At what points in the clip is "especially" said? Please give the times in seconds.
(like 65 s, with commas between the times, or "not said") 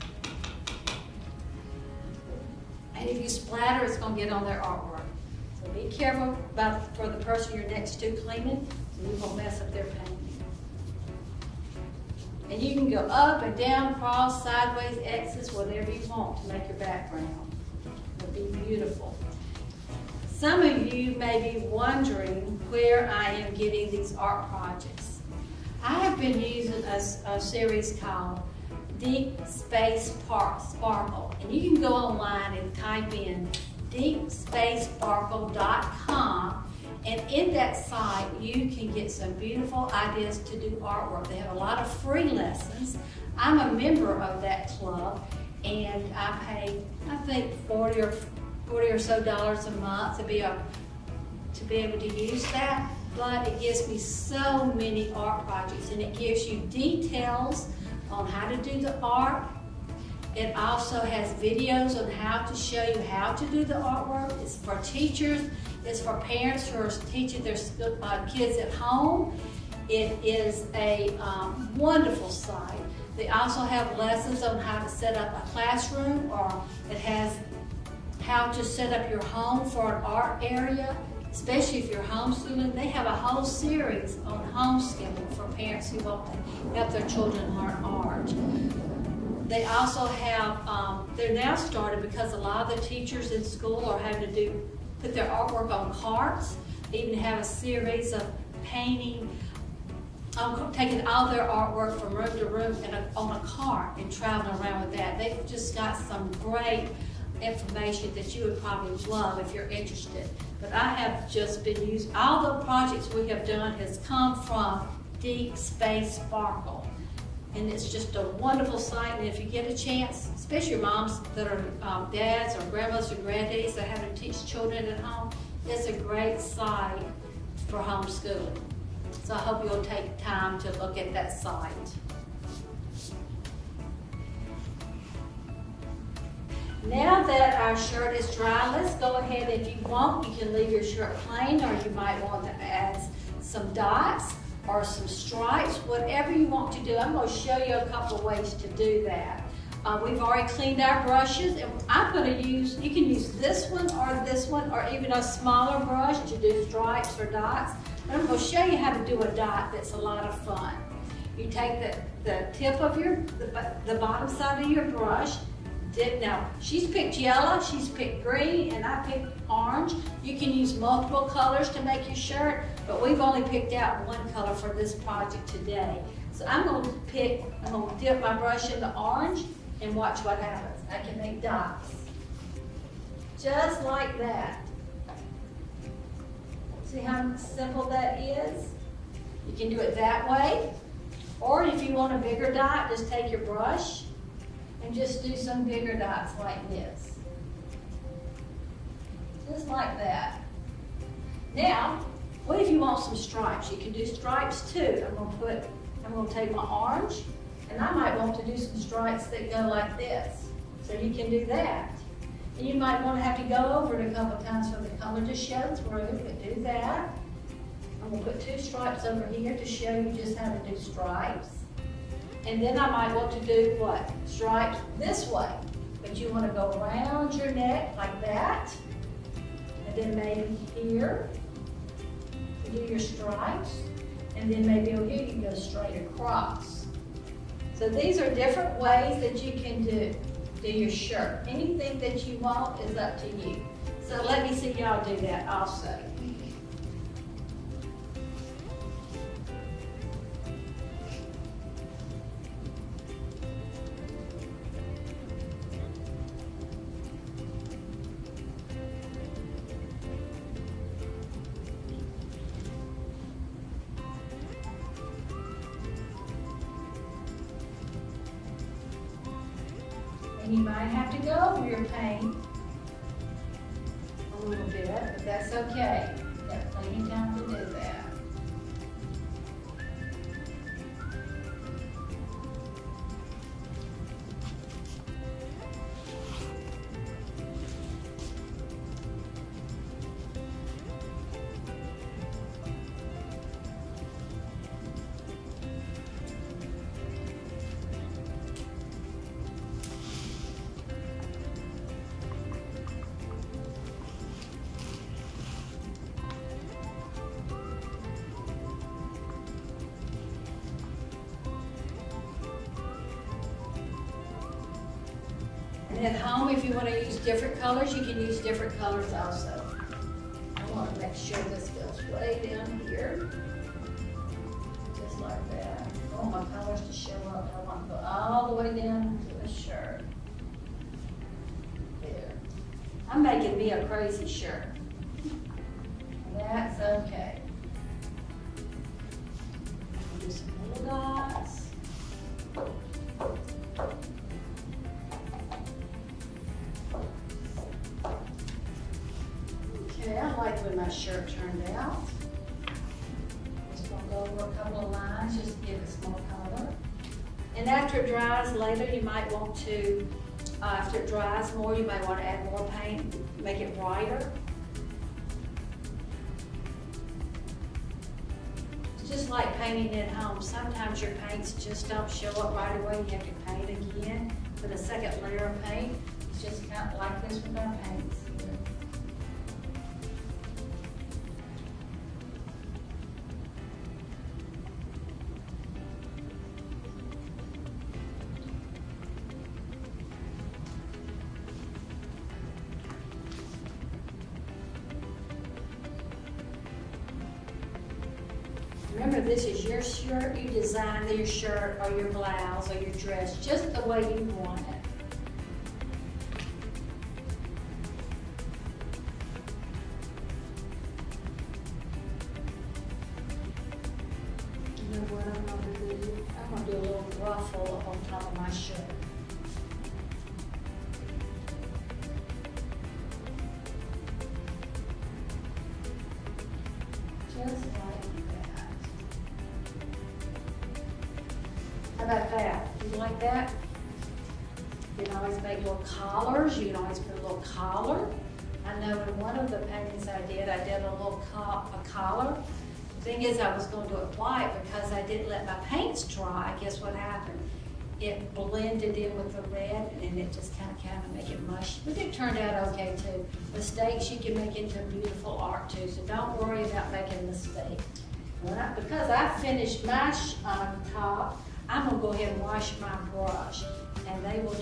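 81 s, 120 s.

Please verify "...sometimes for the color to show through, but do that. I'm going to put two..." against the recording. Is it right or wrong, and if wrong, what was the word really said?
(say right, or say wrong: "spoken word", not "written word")
wrong: "times", not "sometimes".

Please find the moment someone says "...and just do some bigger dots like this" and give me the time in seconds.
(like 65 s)
194 s.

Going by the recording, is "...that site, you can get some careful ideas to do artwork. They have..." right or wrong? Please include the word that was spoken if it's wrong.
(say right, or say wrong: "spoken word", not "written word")
wrong: "beautiful", not "careful".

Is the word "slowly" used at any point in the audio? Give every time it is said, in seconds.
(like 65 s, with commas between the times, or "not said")
not said.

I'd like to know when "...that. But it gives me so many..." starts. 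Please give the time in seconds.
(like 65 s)
52 s.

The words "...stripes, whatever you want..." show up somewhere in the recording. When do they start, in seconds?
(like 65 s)
145 s.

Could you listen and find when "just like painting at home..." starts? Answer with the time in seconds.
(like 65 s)
369 s.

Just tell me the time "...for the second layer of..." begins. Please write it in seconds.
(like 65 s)
374 s.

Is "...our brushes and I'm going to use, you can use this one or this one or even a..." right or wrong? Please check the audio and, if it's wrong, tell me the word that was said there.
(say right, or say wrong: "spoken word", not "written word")
right.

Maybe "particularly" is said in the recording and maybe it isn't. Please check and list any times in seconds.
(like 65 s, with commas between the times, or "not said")
not said.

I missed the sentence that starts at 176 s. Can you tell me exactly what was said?
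So I'm going to pick, I'm going to dip my brush in the orange and watch what happens.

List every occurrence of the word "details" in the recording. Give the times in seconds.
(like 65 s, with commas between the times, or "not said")
56 s.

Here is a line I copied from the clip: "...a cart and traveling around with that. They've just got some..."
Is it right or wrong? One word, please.
right.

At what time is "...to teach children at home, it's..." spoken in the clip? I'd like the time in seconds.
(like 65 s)
124 s.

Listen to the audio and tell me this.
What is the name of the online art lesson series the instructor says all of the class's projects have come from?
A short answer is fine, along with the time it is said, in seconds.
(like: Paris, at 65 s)
Deep Space Sparkle, at 115 s.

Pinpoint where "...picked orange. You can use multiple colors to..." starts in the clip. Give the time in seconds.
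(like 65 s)
169 s.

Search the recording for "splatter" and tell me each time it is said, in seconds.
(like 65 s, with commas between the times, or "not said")
3 s.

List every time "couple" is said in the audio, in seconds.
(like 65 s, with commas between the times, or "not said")
147 s, 214 s.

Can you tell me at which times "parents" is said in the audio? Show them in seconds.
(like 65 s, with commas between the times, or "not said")
66 s, 85 s.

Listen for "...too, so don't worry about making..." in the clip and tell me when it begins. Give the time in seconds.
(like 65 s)
455 s.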